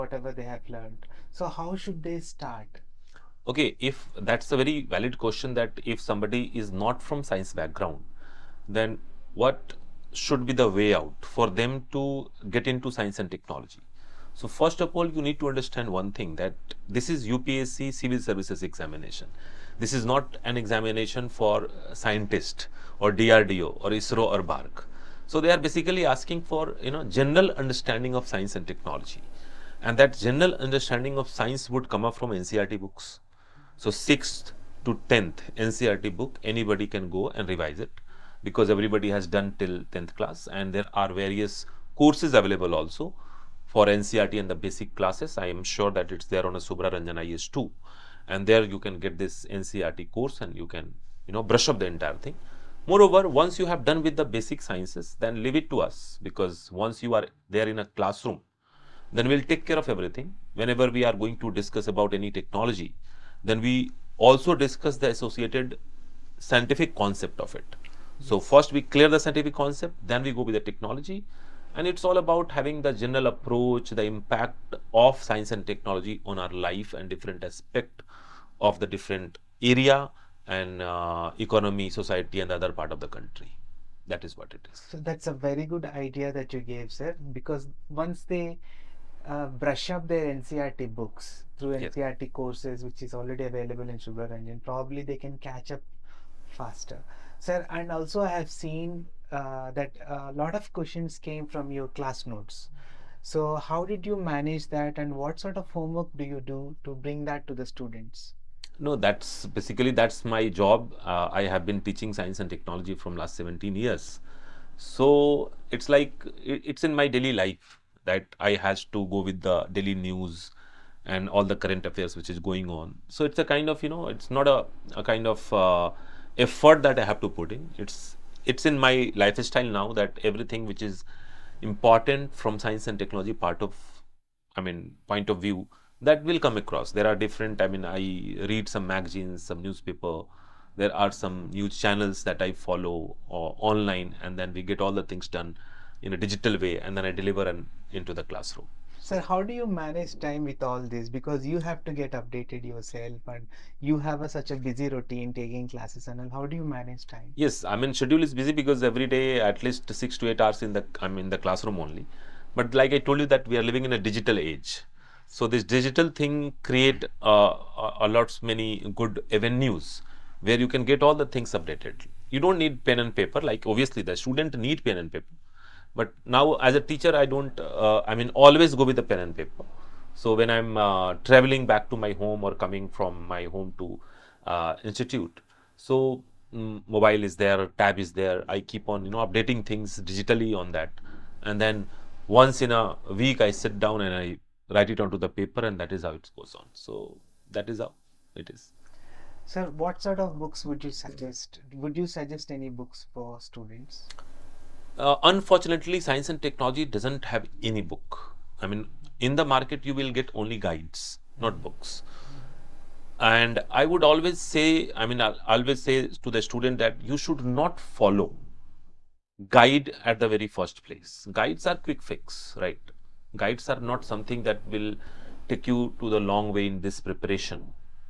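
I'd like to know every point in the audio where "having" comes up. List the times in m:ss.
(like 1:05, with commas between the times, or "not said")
1:12.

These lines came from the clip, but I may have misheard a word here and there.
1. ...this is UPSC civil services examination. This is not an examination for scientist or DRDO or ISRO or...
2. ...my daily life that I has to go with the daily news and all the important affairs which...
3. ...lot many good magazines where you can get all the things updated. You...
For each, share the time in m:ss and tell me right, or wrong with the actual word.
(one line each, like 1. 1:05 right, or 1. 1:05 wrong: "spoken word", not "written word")
1. 0:16 right
2. 1:56 wrong: "current", not "important"
3. 2:48 wrong: "avenues", not "magazines".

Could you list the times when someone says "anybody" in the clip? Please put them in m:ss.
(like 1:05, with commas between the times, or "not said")
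0:36.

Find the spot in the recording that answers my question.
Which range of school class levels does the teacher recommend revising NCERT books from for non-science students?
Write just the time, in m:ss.
0:33.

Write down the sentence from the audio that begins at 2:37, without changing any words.
Yes, I mean, schedule is busy because every day at least six to eight hours in the, I'm in the classroom only.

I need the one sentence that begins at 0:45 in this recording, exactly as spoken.
I am sure that it's there on a Shubhra Ranjan IAS too.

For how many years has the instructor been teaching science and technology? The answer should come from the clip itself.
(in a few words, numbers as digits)
17 years.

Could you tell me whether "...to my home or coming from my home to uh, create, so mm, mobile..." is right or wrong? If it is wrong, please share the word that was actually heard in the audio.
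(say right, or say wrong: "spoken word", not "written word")
wrong: "institute", not "create".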